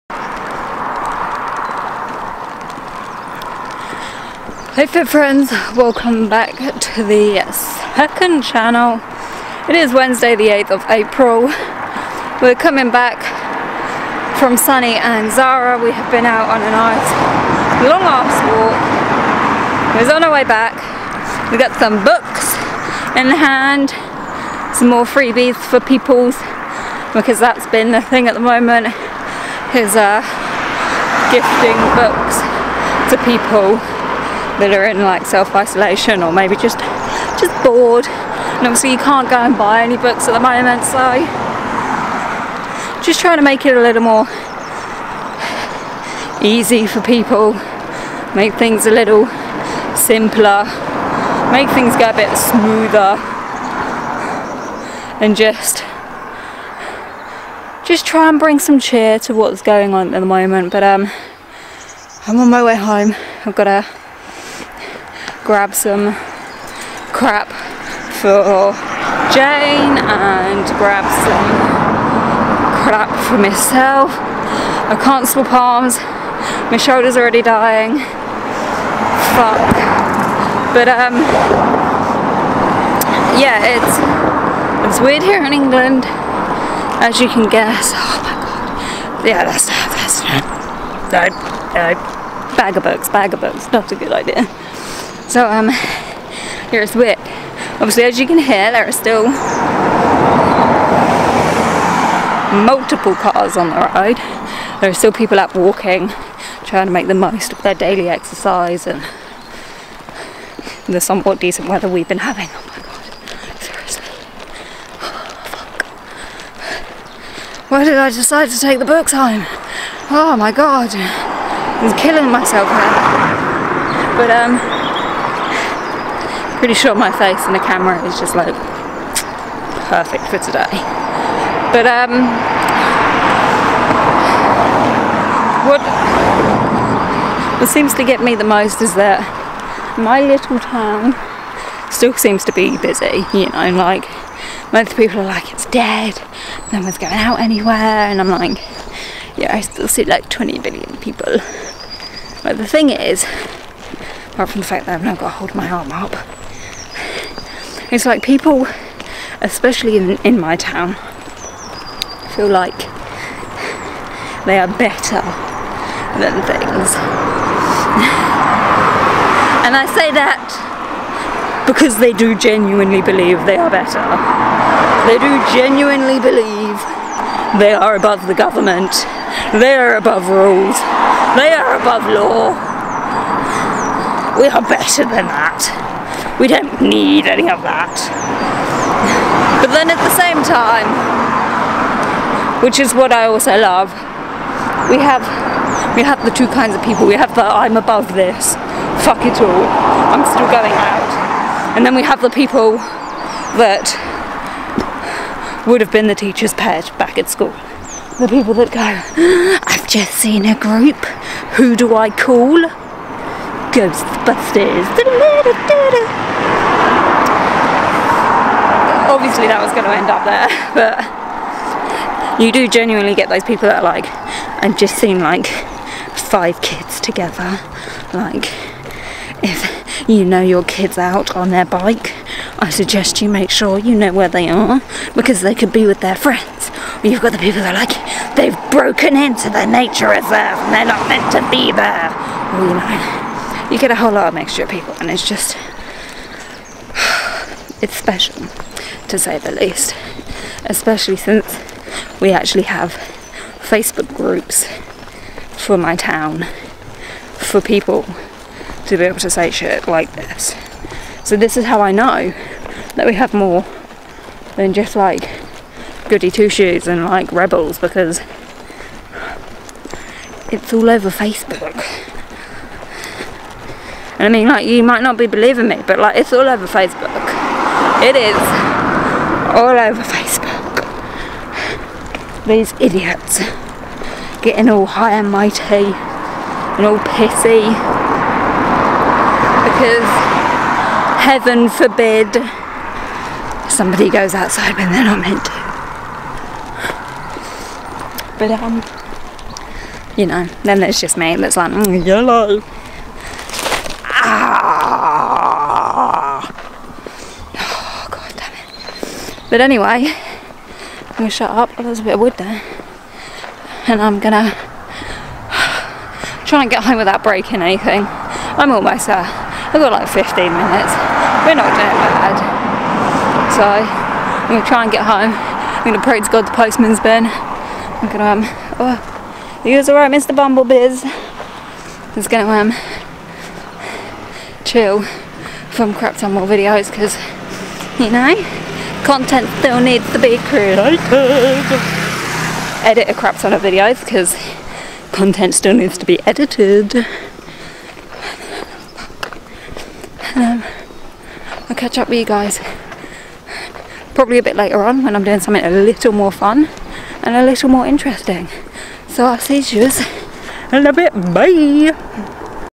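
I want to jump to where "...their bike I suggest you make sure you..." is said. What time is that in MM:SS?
03:51.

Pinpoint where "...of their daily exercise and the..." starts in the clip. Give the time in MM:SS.
01:47.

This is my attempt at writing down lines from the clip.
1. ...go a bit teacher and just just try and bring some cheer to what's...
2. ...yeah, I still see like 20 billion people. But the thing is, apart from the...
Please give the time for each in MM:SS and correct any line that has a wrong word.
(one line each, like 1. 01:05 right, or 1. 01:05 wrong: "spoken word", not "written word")
1. 00:51 wrong: "smoother", not "teacher"
2. 02:29 right.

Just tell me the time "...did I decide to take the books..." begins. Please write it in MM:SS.
01:57.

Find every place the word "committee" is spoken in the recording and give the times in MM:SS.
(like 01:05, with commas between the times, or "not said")
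not said.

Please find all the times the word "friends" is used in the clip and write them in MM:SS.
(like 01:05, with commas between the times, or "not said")
00:05, 03:56.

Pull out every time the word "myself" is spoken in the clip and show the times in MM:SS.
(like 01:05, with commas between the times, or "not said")
01:13, 02:02.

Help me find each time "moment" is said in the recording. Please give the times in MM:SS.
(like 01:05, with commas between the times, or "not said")
00:28, 00:40, 01:00.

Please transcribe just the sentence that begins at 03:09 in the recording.
But then at the same time, which is what I also love, we have we have the two kinds of people.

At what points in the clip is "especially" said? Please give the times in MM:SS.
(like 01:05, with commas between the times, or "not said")
02:39, 04:10.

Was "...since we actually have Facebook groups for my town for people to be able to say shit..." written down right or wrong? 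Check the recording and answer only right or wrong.
right.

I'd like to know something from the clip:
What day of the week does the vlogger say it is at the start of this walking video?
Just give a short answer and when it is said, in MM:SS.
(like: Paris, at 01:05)
Wednesday, at 00:09.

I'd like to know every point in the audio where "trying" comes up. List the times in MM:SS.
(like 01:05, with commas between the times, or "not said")
00:43, 01:46.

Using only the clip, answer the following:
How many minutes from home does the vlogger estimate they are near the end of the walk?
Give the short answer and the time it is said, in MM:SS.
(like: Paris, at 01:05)
15, at 05:20.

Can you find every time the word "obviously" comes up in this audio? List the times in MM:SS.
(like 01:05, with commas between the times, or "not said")
00:38, 01:37, 03:39.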